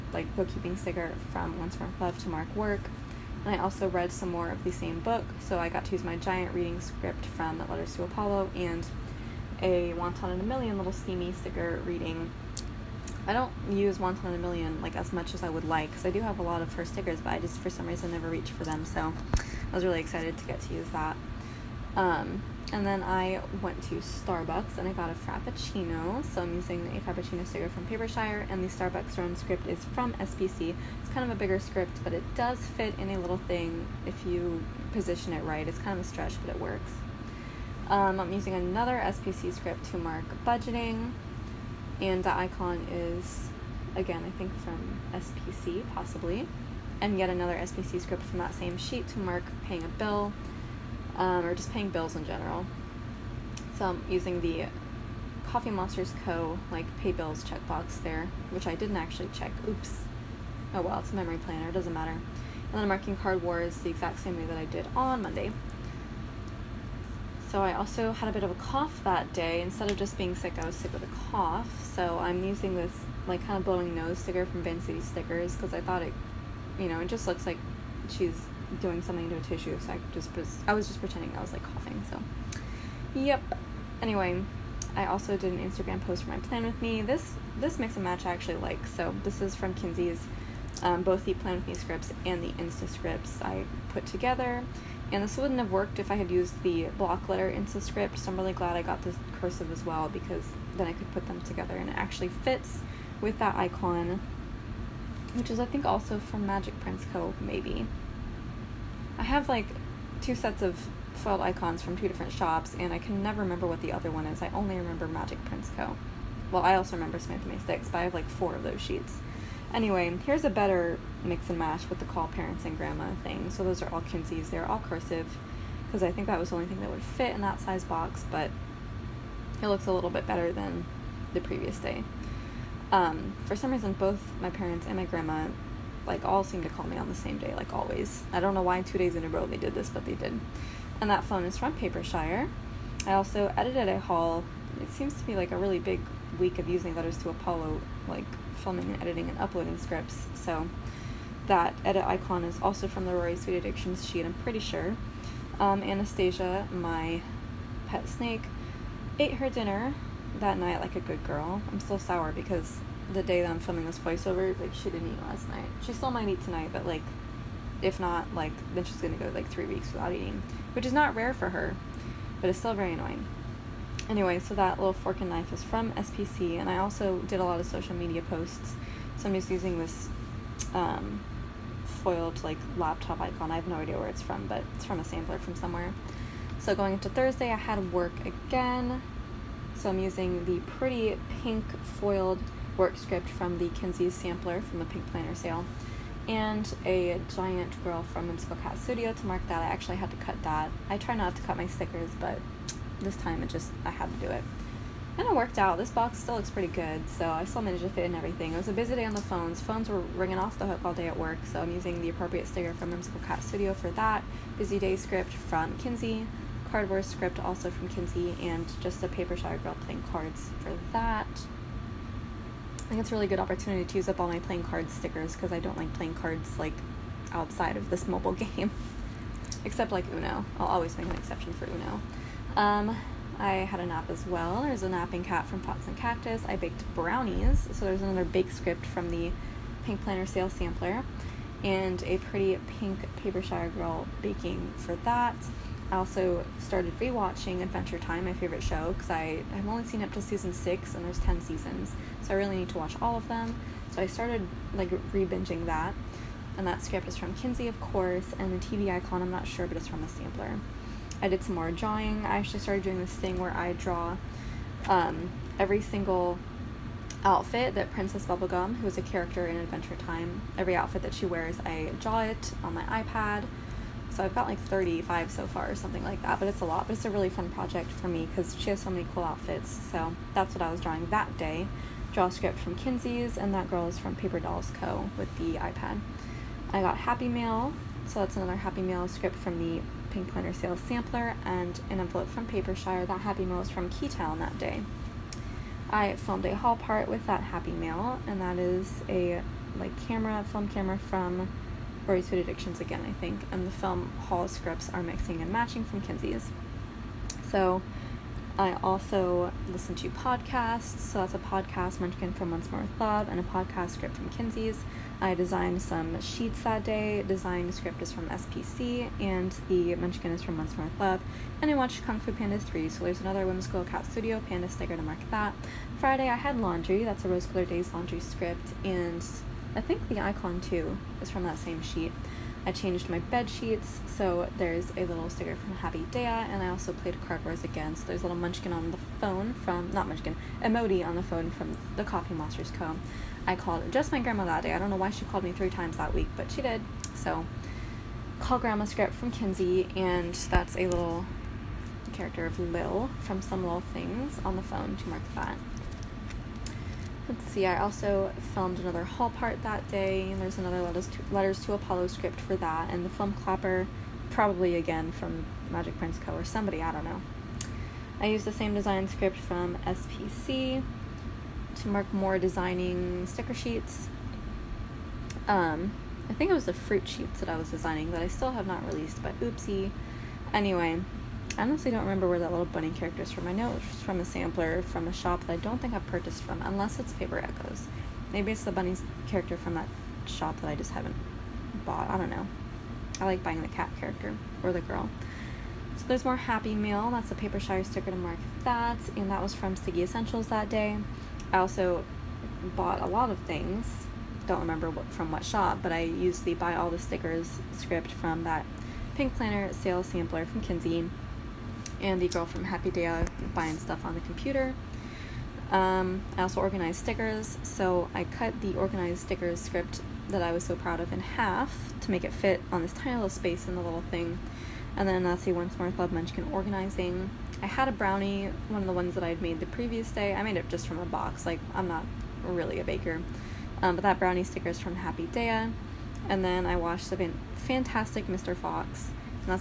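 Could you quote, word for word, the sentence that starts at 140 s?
And that phone is from Papershire.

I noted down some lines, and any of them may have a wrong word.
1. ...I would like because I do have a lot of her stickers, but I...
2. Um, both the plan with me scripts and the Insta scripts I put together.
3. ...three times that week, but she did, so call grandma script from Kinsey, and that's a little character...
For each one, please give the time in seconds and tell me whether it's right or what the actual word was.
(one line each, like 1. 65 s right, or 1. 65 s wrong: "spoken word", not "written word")
1. 15 s right
2. 90 s right
3. 345 s right.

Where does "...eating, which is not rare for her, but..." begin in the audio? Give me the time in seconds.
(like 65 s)
170 s.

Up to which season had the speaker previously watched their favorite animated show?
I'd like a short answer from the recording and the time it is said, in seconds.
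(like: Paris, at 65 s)
season six, at 250 s.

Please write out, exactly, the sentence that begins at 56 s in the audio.
like pay bills checkbox there, which I didn't actually check.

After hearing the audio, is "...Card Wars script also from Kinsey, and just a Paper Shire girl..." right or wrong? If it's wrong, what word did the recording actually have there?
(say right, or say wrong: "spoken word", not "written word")
right.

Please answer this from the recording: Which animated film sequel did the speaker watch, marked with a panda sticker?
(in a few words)
Kung Fu Panda 3.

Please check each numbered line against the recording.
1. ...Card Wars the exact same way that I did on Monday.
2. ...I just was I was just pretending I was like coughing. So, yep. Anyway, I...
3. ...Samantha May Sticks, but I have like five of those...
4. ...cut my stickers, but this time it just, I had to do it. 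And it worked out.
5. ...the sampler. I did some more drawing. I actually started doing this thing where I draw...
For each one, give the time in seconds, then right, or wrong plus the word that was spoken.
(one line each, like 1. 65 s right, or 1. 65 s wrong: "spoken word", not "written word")
1. 63 s right
2. 79 s right
3. 117 s wrong: "four", not "five"
4. 201 s right
5. 260 s right.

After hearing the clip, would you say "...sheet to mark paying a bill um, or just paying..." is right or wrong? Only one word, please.
right.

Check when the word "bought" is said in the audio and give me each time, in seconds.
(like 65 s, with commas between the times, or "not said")
391 s, 402 s.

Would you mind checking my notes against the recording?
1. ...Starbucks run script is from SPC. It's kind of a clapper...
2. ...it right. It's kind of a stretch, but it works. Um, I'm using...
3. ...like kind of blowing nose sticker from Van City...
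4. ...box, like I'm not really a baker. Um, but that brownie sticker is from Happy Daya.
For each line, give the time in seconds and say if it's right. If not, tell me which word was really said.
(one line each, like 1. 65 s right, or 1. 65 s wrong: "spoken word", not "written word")
1. 28 s wrong: "bigger", not "clapper"
2. 35 s right
3. 73 s right
4. 431 s right.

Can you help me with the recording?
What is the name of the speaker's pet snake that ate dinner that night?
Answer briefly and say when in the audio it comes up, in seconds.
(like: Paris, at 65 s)
Anastasia, at 155 s.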